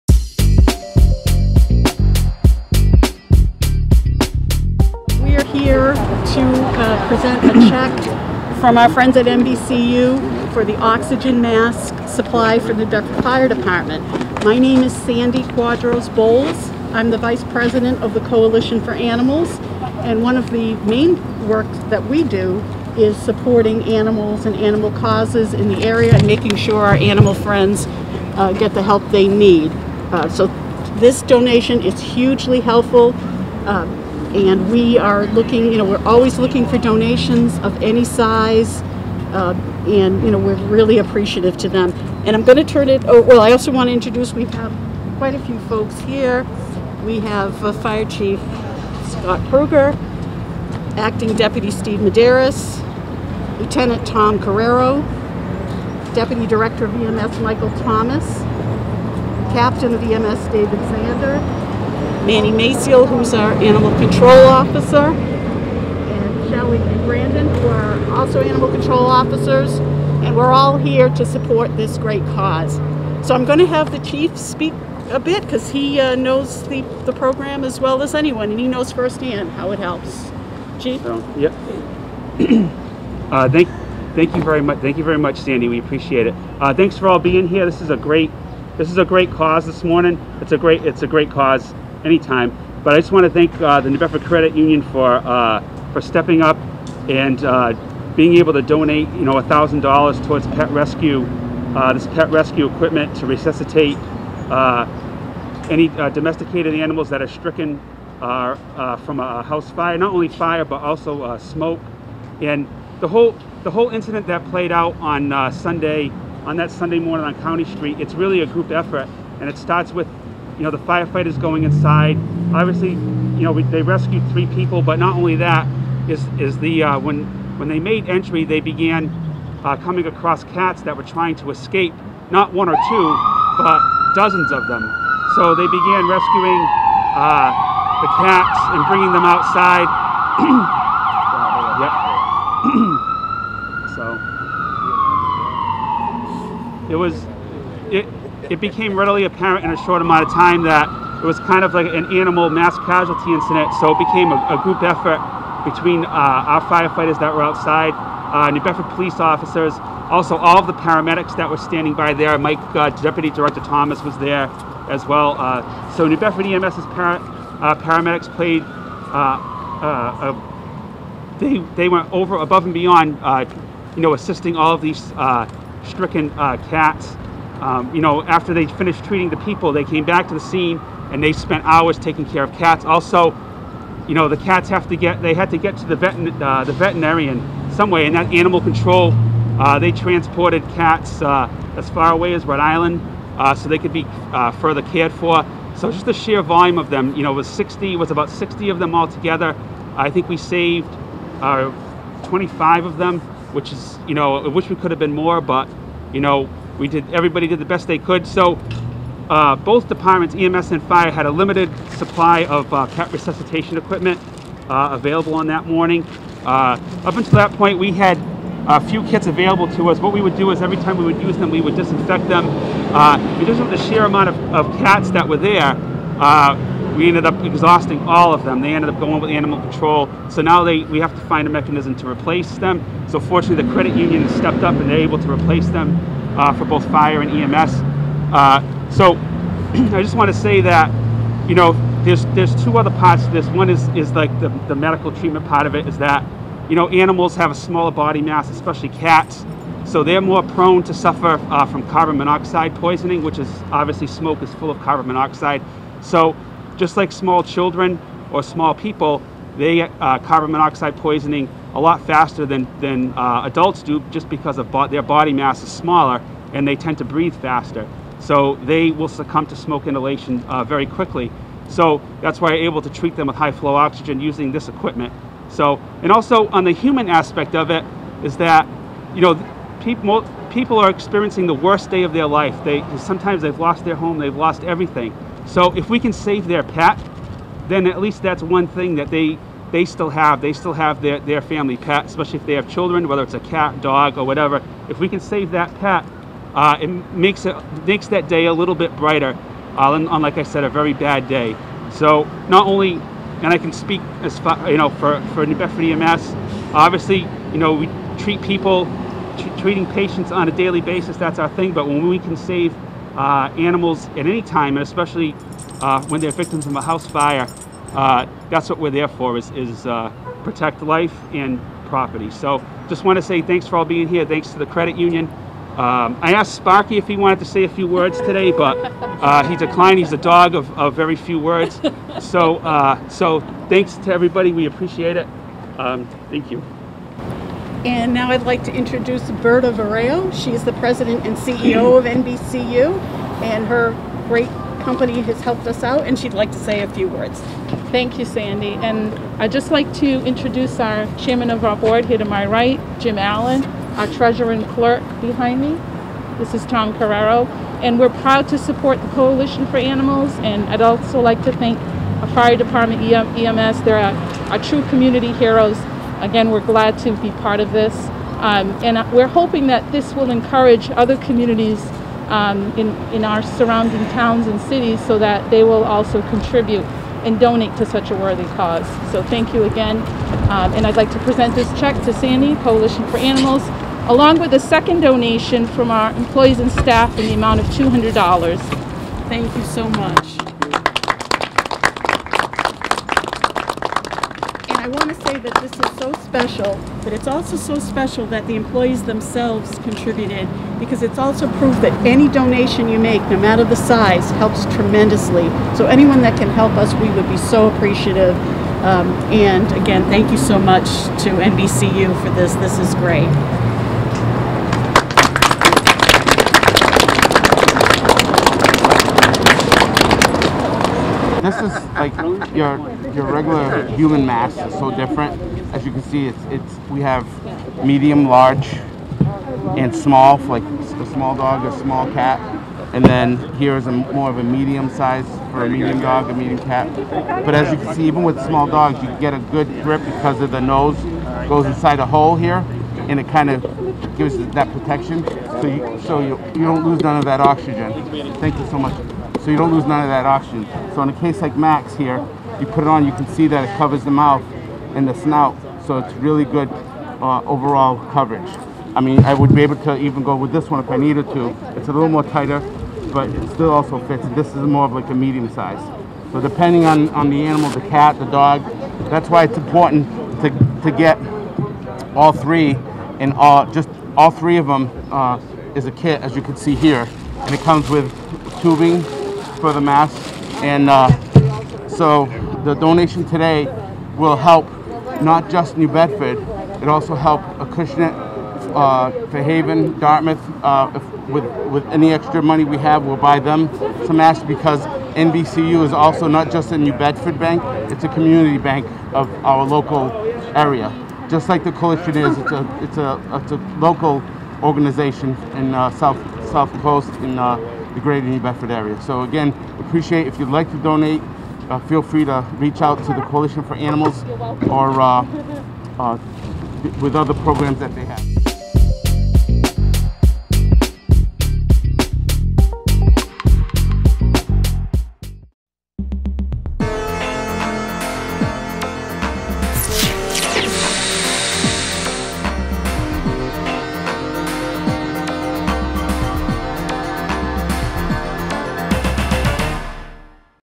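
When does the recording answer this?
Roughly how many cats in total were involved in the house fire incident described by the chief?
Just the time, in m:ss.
3:18.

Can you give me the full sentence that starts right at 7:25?
So you, so you, you don't lose none of that oxygen.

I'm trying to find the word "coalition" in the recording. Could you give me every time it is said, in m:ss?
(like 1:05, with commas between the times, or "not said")
0:18, 5:59, 6:22, 8:21, 8:33.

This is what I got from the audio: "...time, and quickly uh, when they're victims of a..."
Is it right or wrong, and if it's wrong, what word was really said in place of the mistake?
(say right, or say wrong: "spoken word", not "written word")
wrong: "especially", not "quickly".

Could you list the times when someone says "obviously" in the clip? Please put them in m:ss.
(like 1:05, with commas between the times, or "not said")
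2:02, 4:13, 5:06.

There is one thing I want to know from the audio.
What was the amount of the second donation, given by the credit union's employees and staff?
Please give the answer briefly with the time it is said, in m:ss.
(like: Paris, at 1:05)
$200, at 6:27.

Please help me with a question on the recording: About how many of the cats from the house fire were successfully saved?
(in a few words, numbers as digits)
25.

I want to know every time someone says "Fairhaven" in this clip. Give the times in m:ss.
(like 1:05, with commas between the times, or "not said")
8:09.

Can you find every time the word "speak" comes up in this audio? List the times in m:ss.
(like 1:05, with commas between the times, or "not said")
1:14, 5:03.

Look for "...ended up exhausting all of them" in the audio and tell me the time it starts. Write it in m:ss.
3:47.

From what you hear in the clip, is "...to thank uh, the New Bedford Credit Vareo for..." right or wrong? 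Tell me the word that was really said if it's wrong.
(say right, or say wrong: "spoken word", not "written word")
wrong: "Union", not "Vareo".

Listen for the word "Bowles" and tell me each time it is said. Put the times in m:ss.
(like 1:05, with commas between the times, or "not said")
0:16.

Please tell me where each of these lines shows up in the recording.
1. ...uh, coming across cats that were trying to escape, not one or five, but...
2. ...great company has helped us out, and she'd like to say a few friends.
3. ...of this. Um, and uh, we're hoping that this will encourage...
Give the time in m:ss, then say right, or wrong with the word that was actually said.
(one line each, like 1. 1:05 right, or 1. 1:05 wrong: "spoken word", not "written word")
1. 2:09 wrong: "two", not "five"
2. 5:44 wrong: "words", not "friends"
3. 6:07 right.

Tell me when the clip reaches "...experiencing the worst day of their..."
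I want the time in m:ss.
4:40.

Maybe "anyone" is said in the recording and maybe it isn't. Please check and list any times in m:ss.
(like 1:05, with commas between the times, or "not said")
1:18, 6:45.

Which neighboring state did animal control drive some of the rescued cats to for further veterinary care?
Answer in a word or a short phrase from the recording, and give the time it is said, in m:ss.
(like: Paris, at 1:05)
Rhode Island, at 3:12.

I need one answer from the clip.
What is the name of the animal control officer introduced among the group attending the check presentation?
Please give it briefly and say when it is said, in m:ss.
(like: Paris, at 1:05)
Manny Maciel, at 1:02.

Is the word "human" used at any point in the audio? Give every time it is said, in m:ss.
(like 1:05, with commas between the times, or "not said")
4:36, 7:03.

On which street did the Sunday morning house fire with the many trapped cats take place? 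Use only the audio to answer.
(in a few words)
County Street.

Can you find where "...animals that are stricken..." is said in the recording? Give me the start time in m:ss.
1:46.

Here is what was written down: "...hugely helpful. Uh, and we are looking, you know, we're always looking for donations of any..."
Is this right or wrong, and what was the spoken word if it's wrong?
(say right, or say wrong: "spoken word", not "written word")
right.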